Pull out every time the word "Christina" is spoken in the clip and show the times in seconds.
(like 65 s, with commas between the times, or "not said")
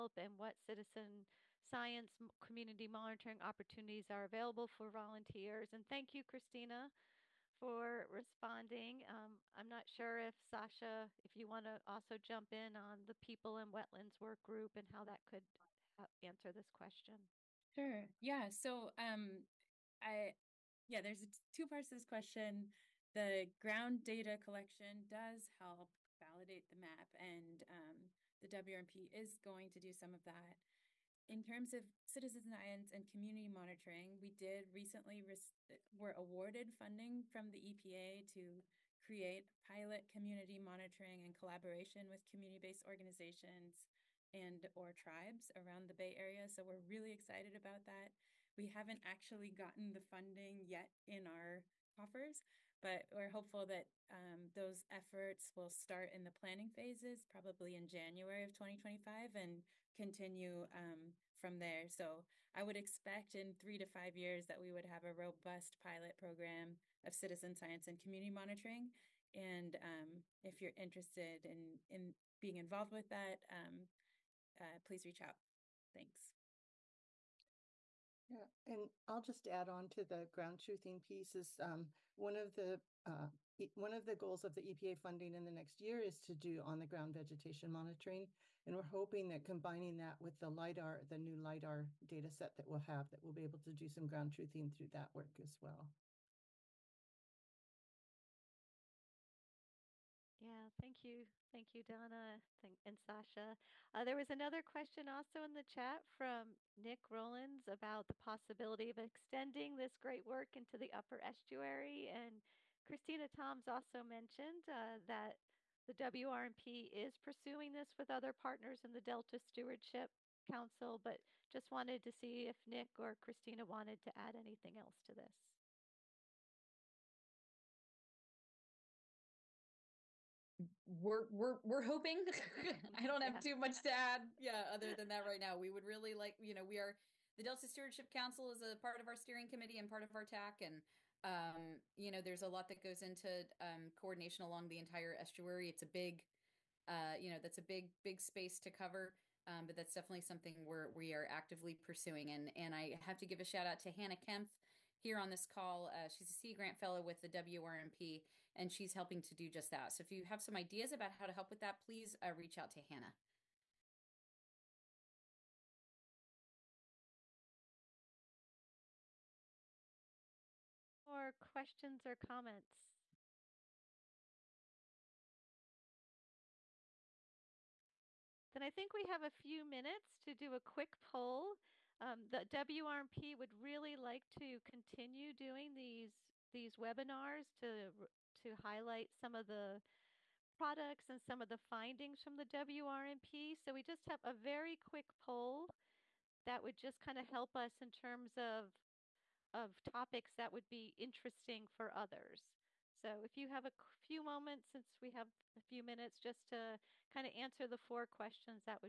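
6 s, 112 s, 123 s.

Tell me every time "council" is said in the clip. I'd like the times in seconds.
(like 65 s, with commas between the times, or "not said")
120 s, 138 s.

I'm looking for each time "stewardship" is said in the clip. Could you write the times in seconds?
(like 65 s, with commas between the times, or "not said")
119 s, 137 s.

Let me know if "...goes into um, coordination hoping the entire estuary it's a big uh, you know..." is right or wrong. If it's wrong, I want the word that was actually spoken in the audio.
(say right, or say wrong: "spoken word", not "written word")
wrong: "along", not "hoping".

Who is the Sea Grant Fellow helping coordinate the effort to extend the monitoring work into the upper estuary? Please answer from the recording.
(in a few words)
Hannah Kempf.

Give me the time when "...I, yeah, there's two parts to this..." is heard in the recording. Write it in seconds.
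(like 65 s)
20 s.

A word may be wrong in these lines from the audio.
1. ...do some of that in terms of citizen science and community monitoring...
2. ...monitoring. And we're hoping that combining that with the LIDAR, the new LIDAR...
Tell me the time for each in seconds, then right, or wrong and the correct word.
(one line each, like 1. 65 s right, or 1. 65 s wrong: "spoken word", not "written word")
1. 29 s right
2. 87 s right.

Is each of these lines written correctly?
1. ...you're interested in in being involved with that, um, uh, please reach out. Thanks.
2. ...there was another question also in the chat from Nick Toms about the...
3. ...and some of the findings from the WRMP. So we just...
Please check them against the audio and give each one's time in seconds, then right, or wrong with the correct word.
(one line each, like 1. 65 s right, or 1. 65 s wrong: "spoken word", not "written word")
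1. 70 s right
2. 104 s wrong: "Rollins", not "Toms"
3. 191 s right.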